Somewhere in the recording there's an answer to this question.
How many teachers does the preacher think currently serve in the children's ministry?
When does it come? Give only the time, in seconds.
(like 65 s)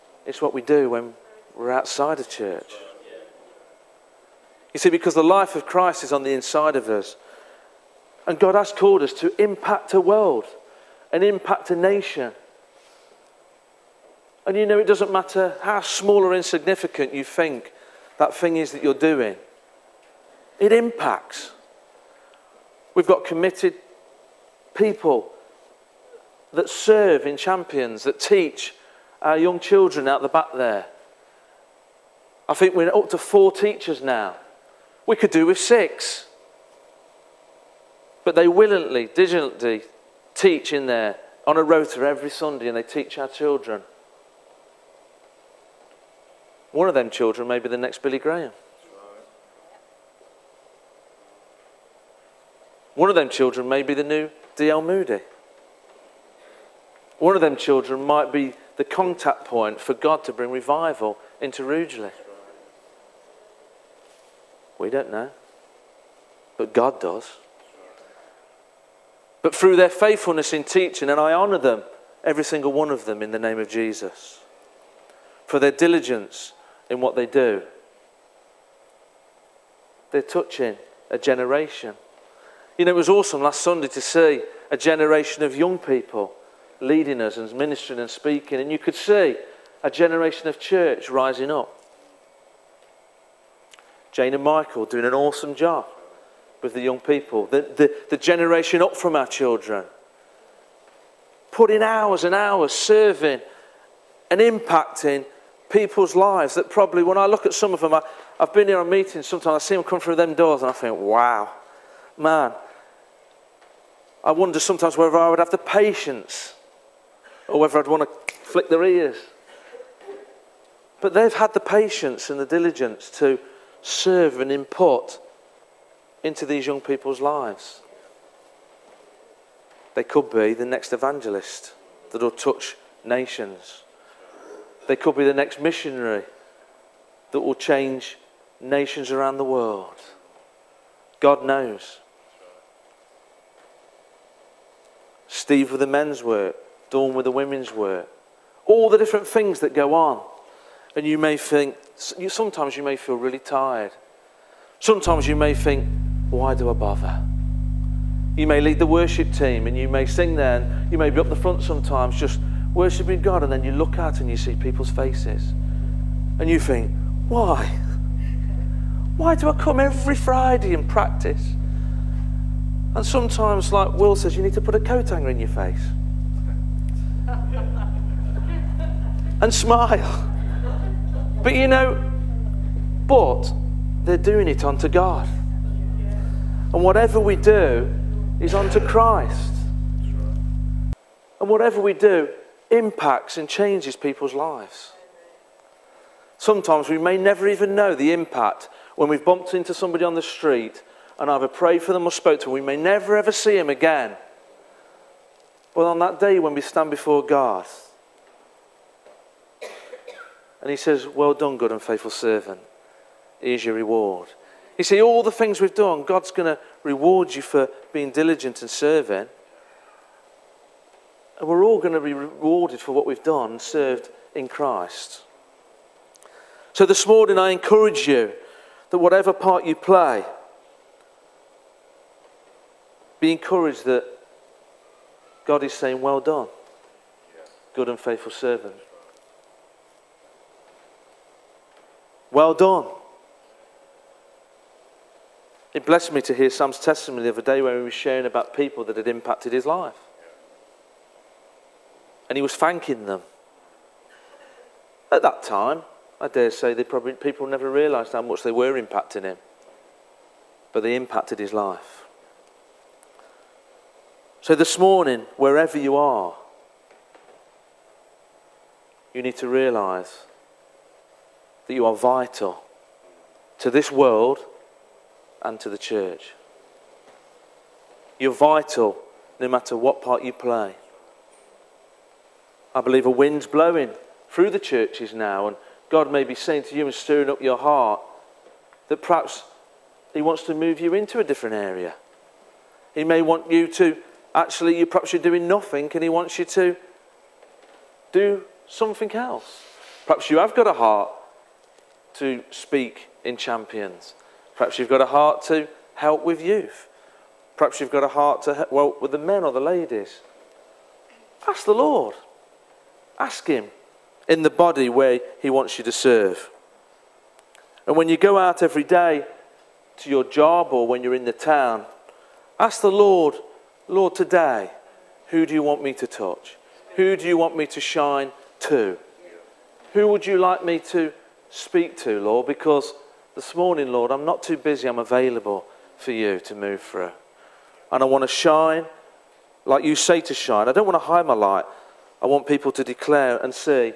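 33 s.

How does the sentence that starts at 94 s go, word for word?
Jane and Michael doing an awesome job with the young people, the, the, the generation up from our children.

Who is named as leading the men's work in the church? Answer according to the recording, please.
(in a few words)
Steve.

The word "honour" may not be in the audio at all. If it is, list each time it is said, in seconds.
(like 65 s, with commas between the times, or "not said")
71 s.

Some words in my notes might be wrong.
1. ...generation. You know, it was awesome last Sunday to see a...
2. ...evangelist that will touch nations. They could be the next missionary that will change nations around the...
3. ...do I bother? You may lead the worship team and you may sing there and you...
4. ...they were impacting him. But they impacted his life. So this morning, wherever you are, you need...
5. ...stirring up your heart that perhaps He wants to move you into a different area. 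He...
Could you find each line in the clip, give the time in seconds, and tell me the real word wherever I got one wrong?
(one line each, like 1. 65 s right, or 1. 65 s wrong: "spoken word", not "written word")
1. 81 s right
2. 130 s right
3. 156 s right
4. 258 s right
5. 286 s right.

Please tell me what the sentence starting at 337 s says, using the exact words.
And I want to shine like you say to shine.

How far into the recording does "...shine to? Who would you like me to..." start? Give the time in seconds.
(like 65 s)
327 s.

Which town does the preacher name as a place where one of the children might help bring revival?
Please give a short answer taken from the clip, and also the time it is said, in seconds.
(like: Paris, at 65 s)
Rugeley, at 61 s.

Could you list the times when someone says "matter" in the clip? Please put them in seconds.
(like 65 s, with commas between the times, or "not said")
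15 s, 279 s.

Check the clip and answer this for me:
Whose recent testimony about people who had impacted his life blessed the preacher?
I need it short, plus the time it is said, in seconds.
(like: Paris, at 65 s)
Sam, at 246 s.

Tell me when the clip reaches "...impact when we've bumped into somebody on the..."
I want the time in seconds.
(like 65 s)
198 s.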